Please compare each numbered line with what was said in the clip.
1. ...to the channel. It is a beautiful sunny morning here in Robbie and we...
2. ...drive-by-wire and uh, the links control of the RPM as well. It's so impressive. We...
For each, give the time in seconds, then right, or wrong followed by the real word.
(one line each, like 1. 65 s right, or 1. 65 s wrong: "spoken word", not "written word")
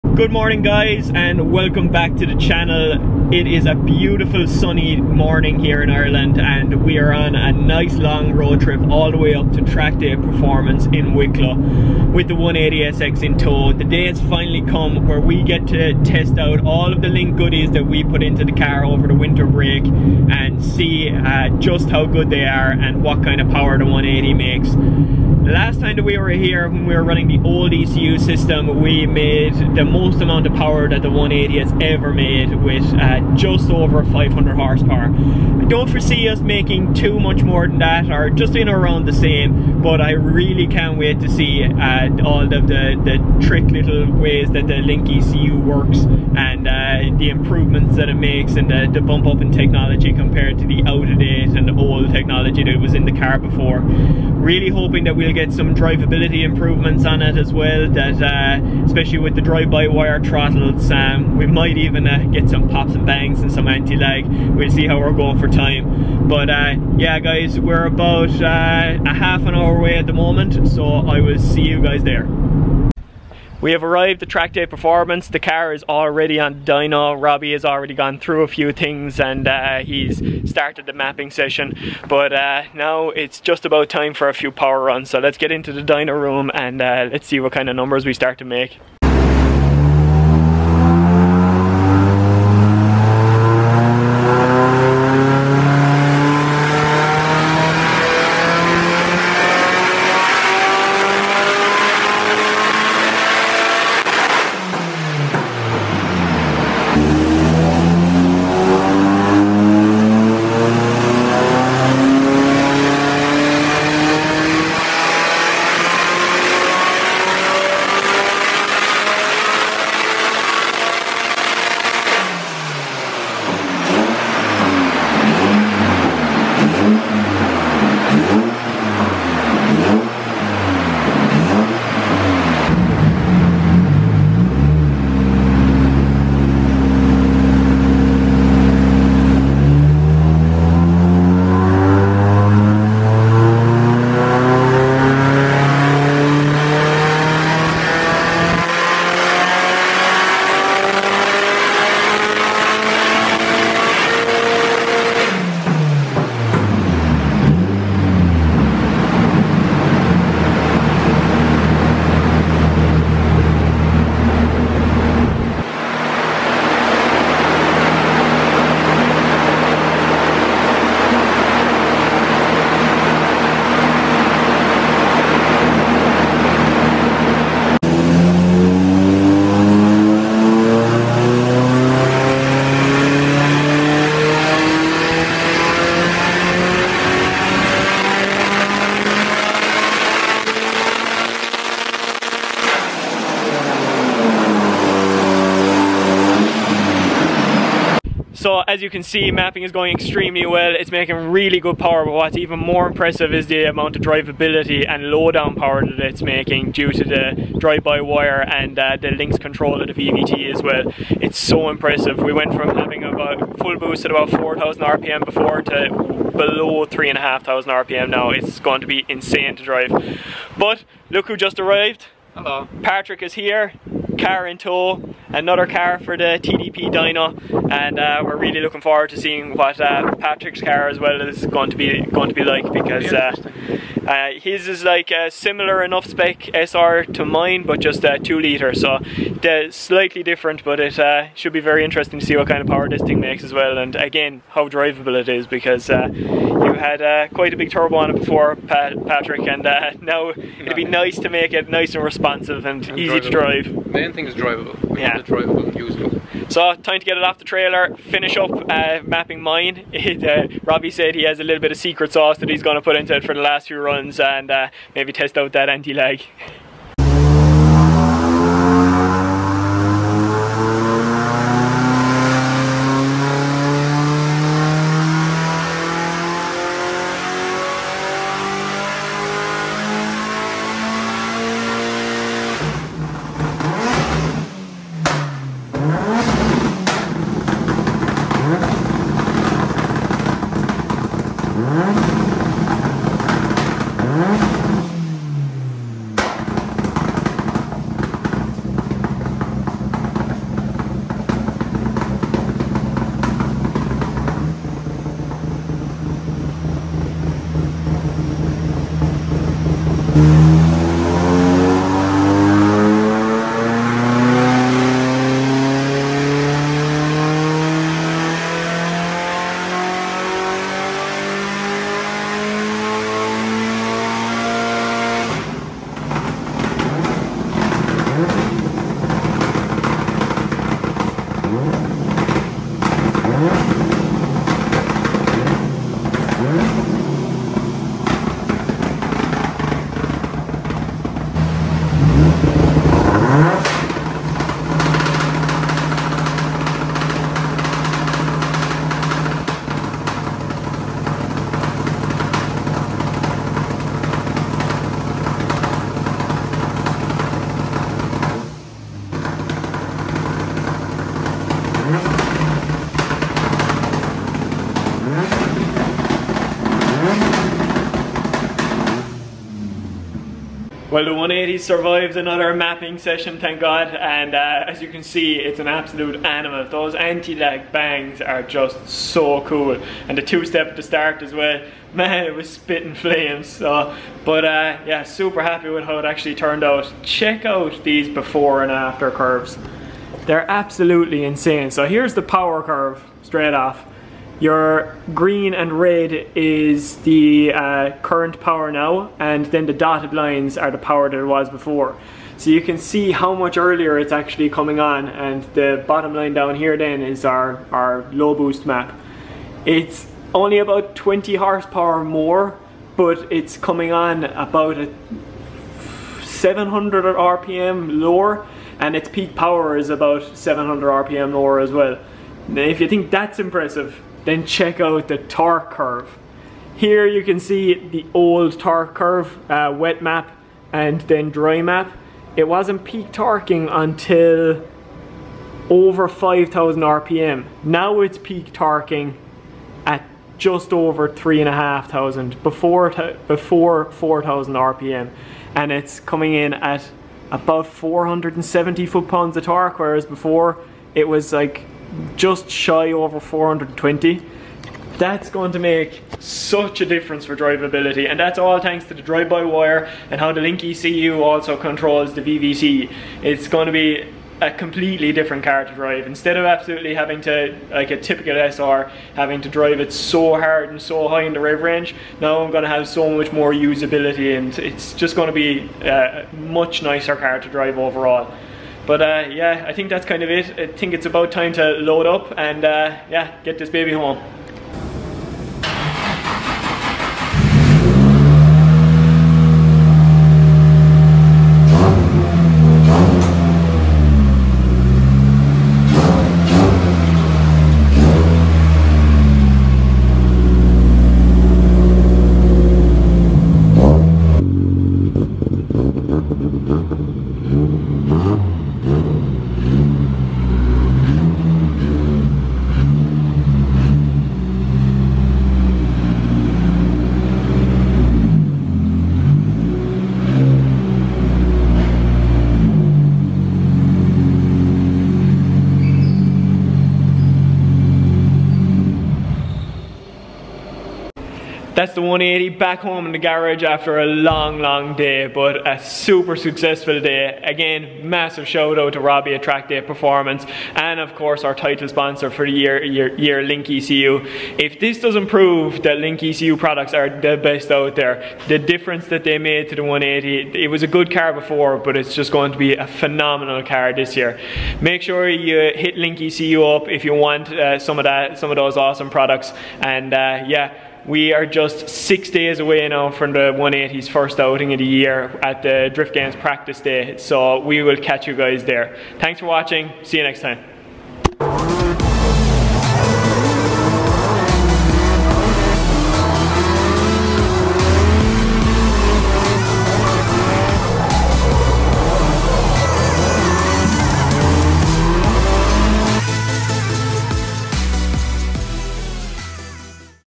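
1. 2 s wrong: "Ireland", not "Robbie"
2. 207 s wrong: "VVT", not "RPM".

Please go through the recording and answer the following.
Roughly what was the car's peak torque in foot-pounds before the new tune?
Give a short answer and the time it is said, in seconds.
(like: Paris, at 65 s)
420, at 453 s.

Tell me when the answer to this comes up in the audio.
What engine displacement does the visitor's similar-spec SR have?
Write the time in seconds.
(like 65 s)
238 s.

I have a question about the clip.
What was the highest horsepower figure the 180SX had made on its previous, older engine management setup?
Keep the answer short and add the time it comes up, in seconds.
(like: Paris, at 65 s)
just over 500 horsepower, at 33 s.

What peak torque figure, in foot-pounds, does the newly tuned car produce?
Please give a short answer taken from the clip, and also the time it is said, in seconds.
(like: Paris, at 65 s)
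470, at 447 s.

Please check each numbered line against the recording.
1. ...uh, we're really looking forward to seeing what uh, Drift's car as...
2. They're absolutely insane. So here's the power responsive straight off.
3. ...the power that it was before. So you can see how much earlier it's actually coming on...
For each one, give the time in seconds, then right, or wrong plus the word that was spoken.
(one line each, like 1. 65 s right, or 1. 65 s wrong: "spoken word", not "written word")
1. 227 s wrong: "Patrick", not "Drift"
2. 390 s wrong: "curve", not "responsive"
3. 400 s right.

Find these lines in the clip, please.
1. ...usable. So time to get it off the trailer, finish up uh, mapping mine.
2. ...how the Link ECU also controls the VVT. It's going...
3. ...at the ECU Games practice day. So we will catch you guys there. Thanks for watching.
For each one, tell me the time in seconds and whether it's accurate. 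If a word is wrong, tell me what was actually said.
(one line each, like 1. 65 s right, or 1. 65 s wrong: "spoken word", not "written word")
1. 255 s right
2. 460 s right
3. 565 s wrong: "Drift", not "ECU".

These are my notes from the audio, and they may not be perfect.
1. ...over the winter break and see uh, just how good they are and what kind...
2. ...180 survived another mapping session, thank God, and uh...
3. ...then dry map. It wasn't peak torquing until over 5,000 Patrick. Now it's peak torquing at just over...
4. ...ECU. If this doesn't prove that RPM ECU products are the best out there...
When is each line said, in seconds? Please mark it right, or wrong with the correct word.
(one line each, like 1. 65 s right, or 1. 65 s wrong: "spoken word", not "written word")
1. 18 s right
2. 371 s right
3. 431 s wrong: "RPM", not "Patrick"
4. 543 s wrong: "Link", not "RPM".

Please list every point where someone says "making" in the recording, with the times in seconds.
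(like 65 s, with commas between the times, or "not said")
36 s, 200 s, 206 s.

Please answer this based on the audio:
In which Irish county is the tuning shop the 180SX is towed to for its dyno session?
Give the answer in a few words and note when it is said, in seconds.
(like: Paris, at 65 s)
Wicklow, at 11 s.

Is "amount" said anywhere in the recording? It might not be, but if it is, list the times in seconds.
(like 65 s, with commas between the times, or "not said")
30 s, 203 s.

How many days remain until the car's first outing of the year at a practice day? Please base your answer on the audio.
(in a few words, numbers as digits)
6.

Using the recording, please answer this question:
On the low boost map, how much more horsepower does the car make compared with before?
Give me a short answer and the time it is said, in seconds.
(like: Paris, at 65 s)
20 horsepower, at 410 s.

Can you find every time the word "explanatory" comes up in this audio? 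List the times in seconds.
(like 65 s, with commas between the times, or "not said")
not said.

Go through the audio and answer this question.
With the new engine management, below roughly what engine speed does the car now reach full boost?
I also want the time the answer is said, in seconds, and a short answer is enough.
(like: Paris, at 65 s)
3,500 RPM, at 216 s.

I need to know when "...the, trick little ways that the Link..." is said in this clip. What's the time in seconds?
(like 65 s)
43 s.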